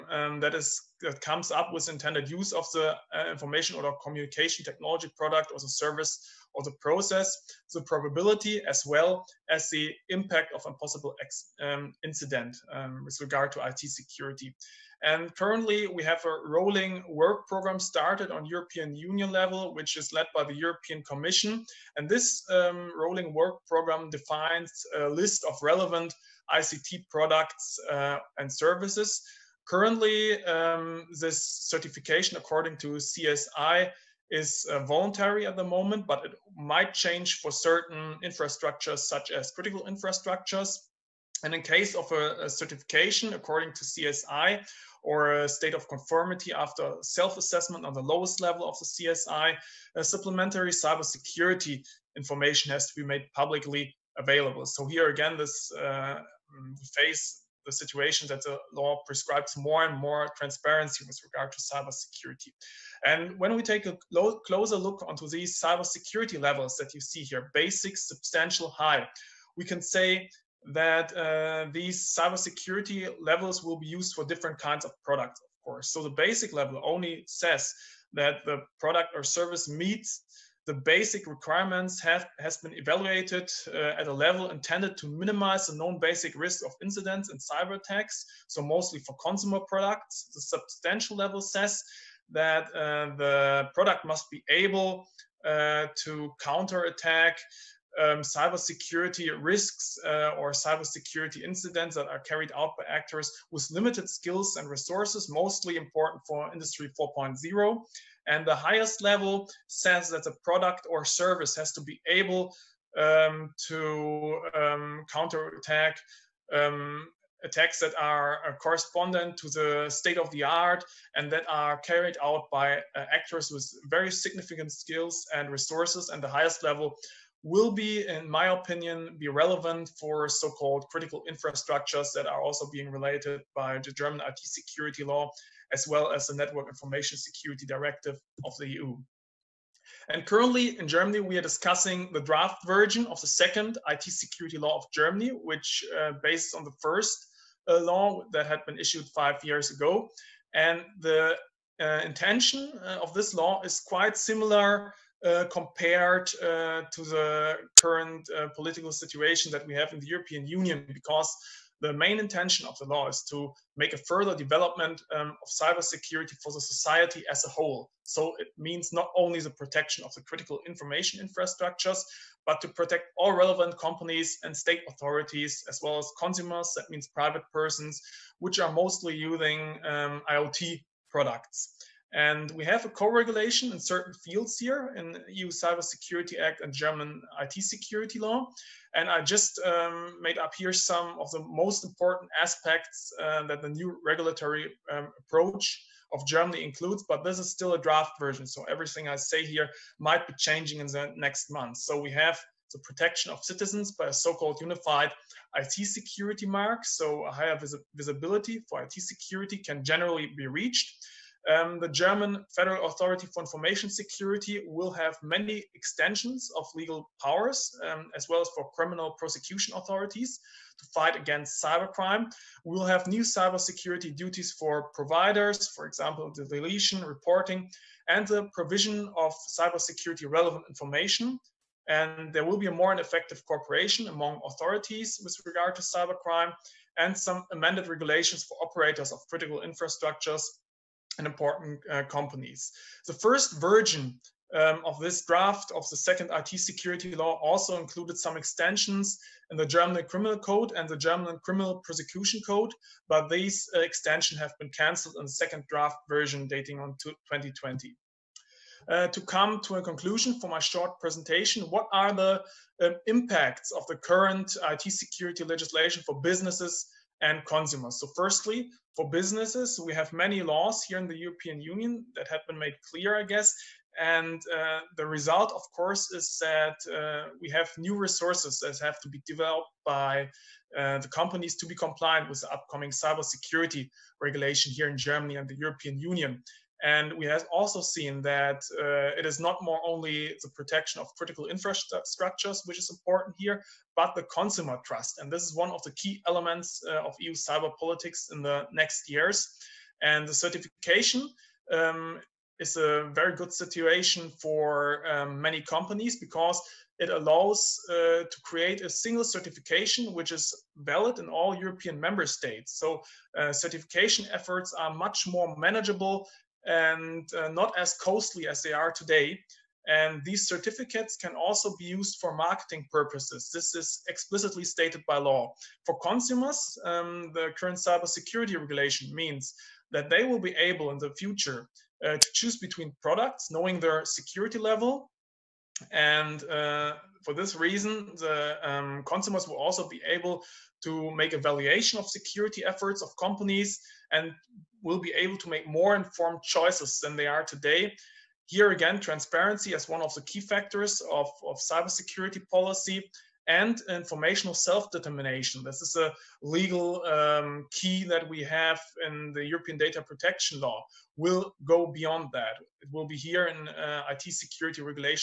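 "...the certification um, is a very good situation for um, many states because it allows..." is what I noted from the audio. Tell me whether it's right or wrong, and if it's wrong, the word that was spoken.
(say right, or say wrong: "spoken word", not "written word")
wrong: "companies", not "states".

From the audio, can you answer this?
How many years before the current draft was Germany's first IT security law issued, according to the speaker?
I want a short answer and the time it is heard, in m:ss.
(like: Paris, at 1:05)
5 years, at 2:29.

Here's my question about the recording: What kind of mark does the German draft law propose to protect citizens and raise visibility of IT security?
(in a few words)
unified IT security mark.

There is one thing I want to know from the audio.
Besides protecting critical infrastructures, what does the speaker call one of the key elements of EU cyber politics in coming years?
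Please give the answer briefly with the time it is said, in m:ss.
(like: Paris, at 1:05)
consumer trust, at 4:54.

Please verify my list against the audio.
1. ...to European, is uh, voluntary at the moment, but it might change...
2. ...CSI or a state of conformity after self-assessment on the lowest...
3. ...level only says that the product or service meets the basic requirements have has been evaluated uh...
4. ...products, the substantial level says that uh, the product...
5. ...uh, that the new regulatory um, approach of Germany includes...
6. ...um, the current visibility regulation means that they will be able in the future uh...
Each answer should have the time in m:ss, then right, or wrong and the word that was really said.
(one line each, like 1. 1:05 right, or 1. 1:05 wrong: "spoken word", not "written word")
1. 0:32 wrong: "CSI", not "European"
2. 0:43 right
3. 1:16 right
4. 1:29 right
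5. 3:13 right
6. 5:26 wrong: "cybersecurity", not "visibility".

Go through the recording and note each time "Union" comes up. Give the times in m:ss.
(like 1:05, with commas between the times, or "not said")
0:18, 2:40, 4:31, 4:45.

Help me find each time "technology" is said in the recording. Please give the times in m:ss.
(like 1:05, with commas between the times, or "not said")
0:04.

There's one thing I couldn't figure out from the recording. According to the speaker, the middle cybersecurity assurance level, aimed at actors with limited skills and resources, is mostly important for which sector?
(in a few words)
Industry 4.0.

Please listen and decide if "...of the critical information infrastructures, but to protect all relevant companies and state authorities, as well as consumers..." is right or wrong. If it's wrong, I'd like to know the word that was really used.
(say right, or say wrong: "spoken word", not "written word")
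right.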